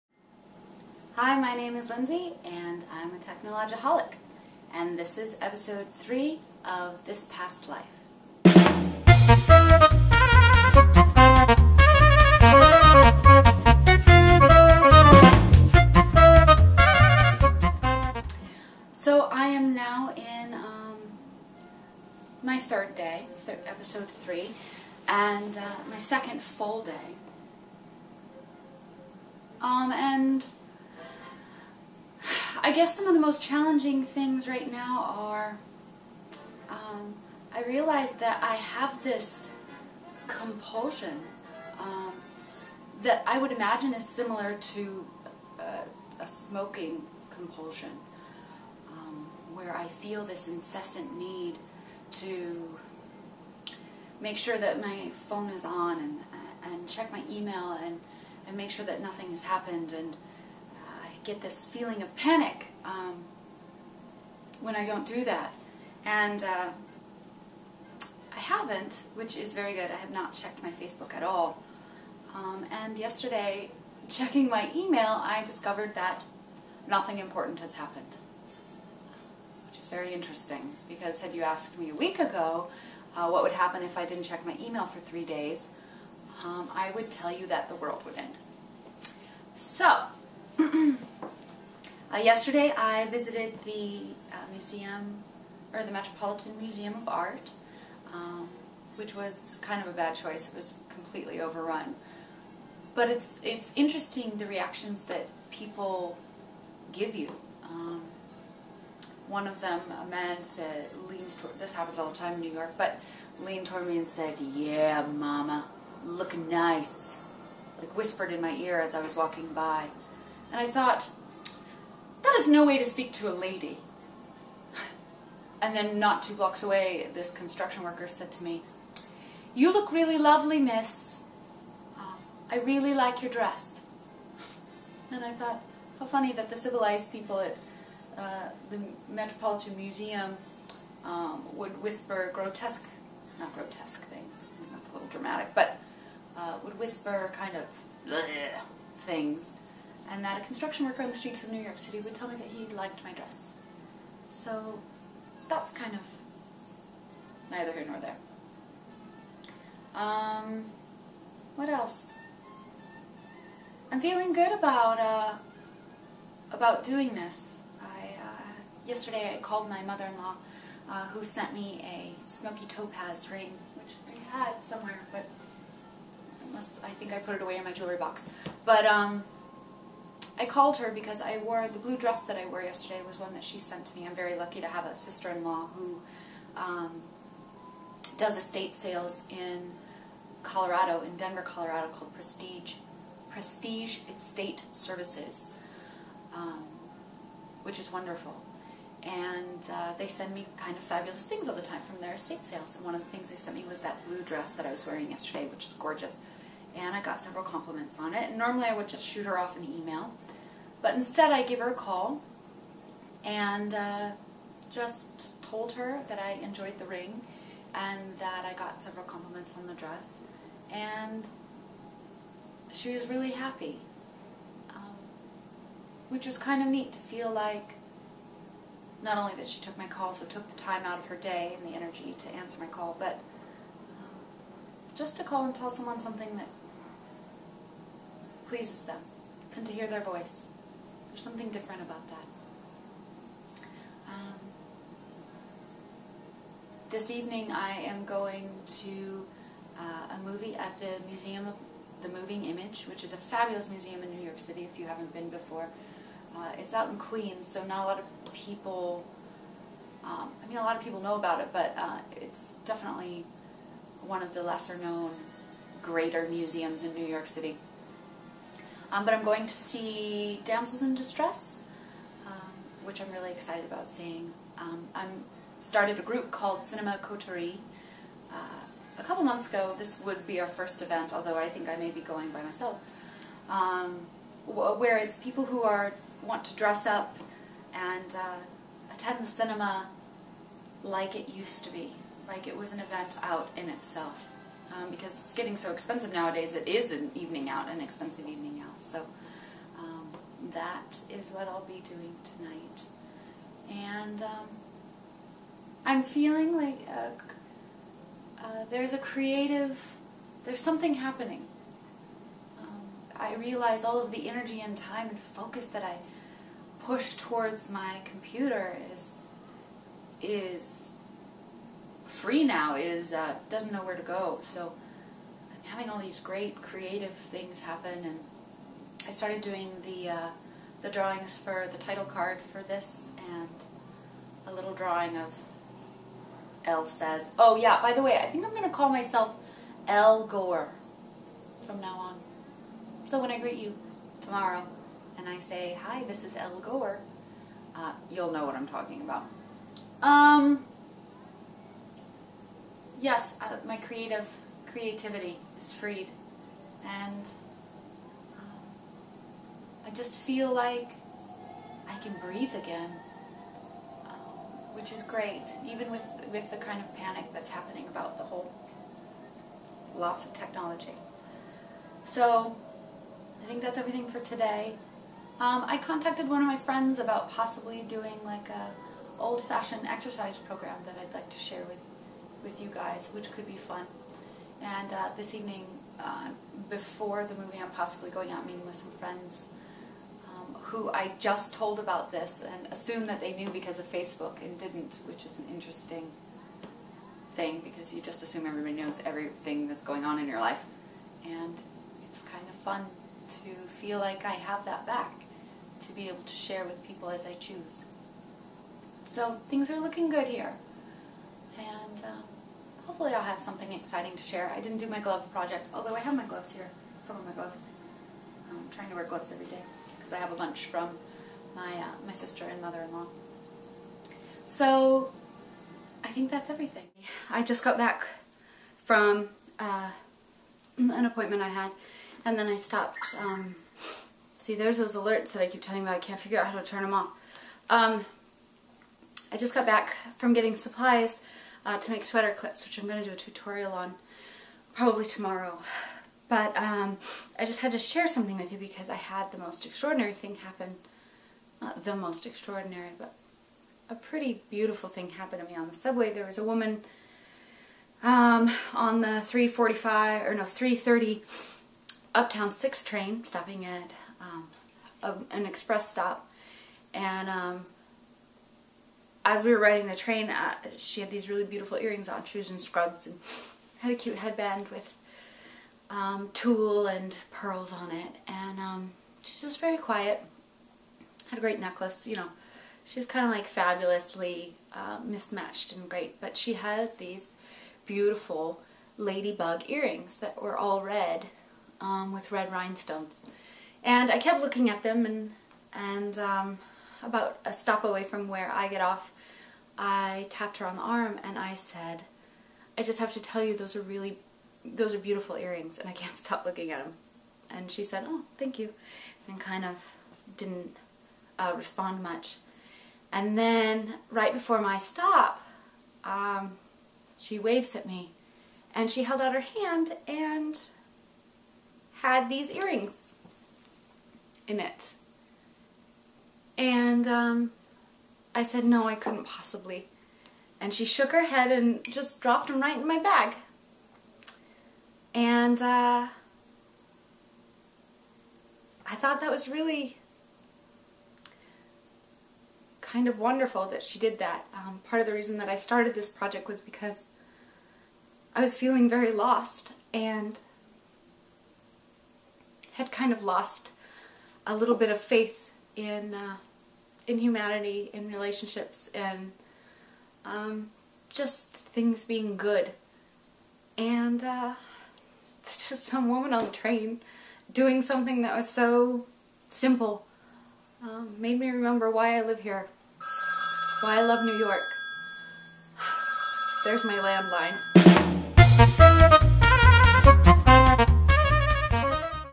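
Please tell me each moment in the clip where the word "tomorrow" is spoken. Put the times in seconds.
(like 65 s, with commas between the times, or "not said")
344 s, 445 s.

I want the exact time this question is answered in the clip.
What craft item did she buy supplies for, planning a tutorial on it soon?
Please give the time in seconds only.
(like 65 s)
442 s.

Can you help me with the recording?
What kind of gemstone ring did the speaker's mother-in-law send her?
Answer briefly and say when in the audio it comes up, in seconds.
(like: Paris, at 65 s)
Smoky topaz, at 172 s.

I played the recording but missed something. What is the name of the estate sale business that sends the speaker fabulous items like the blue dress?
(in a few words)
Prestige Estate Services.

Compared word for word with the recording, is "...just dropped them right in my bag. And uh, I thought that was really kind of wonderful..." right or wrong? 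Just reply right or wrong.
right.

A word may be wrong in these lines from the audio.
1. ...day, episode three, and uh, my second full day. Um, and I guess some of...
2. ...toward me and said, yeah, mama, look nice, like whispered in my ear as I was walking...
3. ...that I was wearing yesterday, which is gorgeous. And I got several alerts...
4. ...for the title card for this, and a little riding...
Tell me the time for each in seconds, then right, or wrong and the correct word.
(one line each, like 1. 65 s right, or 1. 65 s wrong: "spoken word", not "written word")
1. 22 s right
2. 113 s right
3. 204 s wrong: "compliments", not "alerts"
4. 331 s wrong: "drawing", not "riding".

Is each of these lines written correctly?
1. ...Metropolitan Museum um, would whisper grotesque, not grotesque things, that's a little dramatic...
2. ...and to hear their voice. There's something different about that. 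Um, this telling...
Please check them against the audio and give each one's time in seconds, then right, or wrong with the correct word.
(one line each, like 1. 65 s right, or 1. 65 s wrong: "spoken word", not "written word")
1. 139 s right
2. 239 s wrong: "evening", not "telling".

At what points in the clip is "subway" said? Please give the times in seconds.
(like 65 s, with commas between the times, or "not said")
455 s.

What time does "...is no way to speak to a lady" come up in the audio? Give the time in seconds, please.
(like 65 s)
122 s.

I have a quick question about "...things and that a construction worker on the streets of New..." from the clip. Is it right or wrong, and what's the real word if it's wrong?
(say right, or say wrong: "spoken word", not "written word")
right.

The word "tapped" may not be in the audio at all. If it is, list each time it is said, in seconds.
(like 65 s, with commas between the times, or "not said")
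500 s.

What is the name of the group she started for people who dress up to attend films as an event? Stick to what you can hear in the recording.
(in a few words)
Cinema Coterie.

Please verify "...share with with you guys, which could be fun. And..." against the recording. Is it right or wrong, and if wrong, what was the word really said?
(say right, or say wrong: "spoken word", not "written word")
right.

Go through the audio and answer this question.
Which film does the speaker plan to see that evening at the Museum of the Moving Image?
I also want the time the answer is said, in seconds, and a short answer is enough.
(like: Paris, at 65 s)
Damsels in Distress, at 270 s.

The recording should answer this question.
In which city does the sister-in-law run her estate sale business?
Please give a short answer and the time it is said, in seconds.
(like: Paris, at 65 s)
Denver, at 191 s.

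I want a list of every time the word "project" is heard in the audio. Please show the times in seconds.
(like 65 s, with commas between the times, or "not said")
415 s, 546 s.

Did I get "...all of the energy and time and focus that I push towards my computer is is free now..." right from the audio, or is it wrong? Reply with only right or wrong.
right.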